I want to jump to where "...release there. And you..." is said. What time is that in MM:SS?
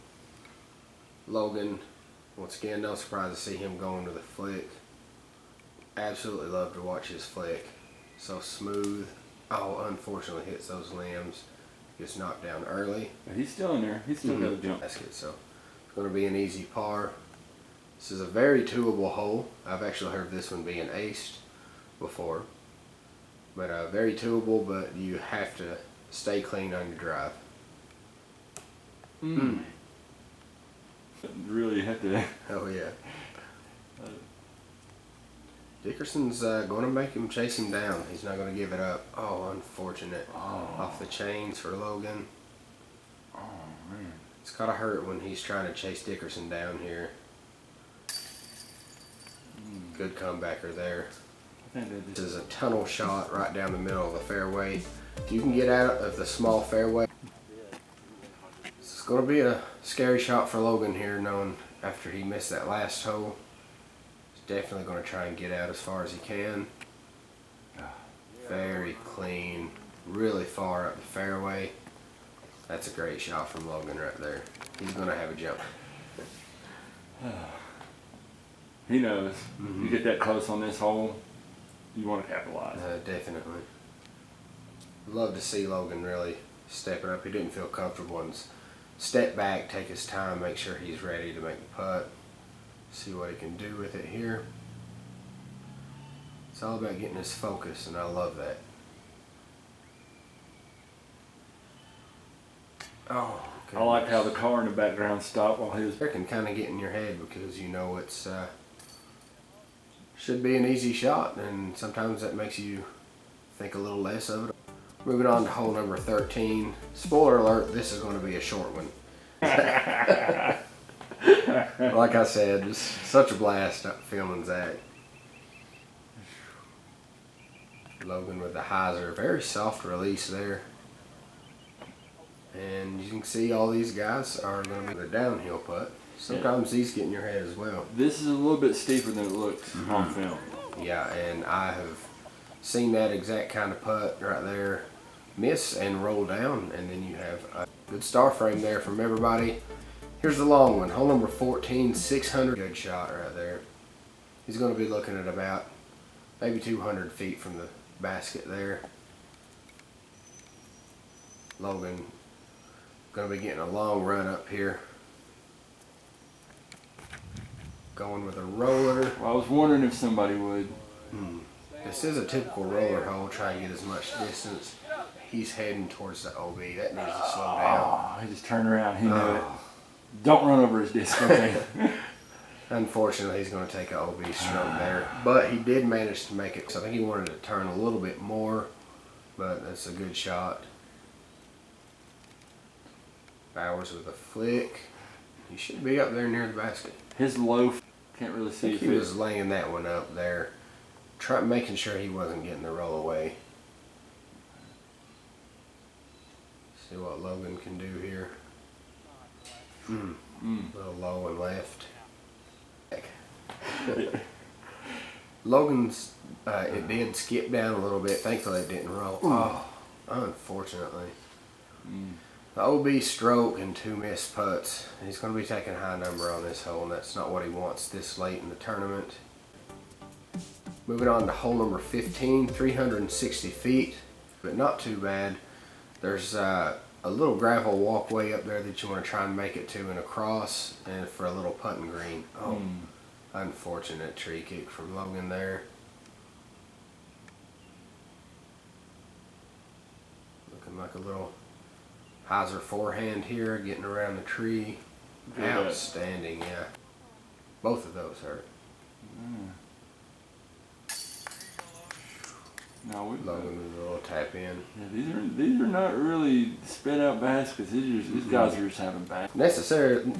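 02:09.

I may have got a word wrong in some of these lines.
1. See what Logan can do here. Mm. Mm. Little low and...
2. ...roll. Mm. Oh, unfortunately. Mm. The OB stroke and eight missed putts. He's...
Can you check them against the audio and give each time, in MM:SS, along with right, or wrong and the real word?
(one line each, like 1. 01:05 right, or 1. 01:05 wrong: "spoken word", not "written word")
1. 03:26 right
2. 03:38 wrong: "two", not "eight".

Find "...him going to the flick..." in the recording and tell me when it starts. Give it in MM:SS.
00:03.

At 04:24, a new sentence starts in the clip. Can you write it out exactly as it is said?
Yeah, these are these are not really spread out baskets.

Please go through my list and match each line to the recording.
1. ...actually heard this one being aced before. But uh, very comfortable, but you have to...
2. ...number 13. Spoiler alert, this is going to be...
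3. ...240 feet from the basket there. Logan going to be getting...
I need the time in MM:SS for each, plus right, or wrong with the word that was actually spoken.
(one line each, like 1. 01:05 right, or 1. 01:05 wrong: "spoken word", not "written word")
1. 00:19 wrong: "twoable", not "comfortable"
2. 01:55 right
3. 02:36 wrong: "200", not "240".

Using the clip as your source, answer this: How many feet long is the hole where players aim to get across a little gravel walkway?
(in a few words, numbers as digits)
360 feet.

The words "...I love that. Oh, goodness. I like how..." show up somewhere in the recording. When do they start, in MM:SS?
01:37.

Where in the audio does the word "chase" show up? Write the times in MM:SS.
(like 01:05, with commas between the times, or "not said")
00:37, 00:45.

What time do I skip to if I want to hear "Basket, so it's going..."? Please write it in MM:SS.
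00:14.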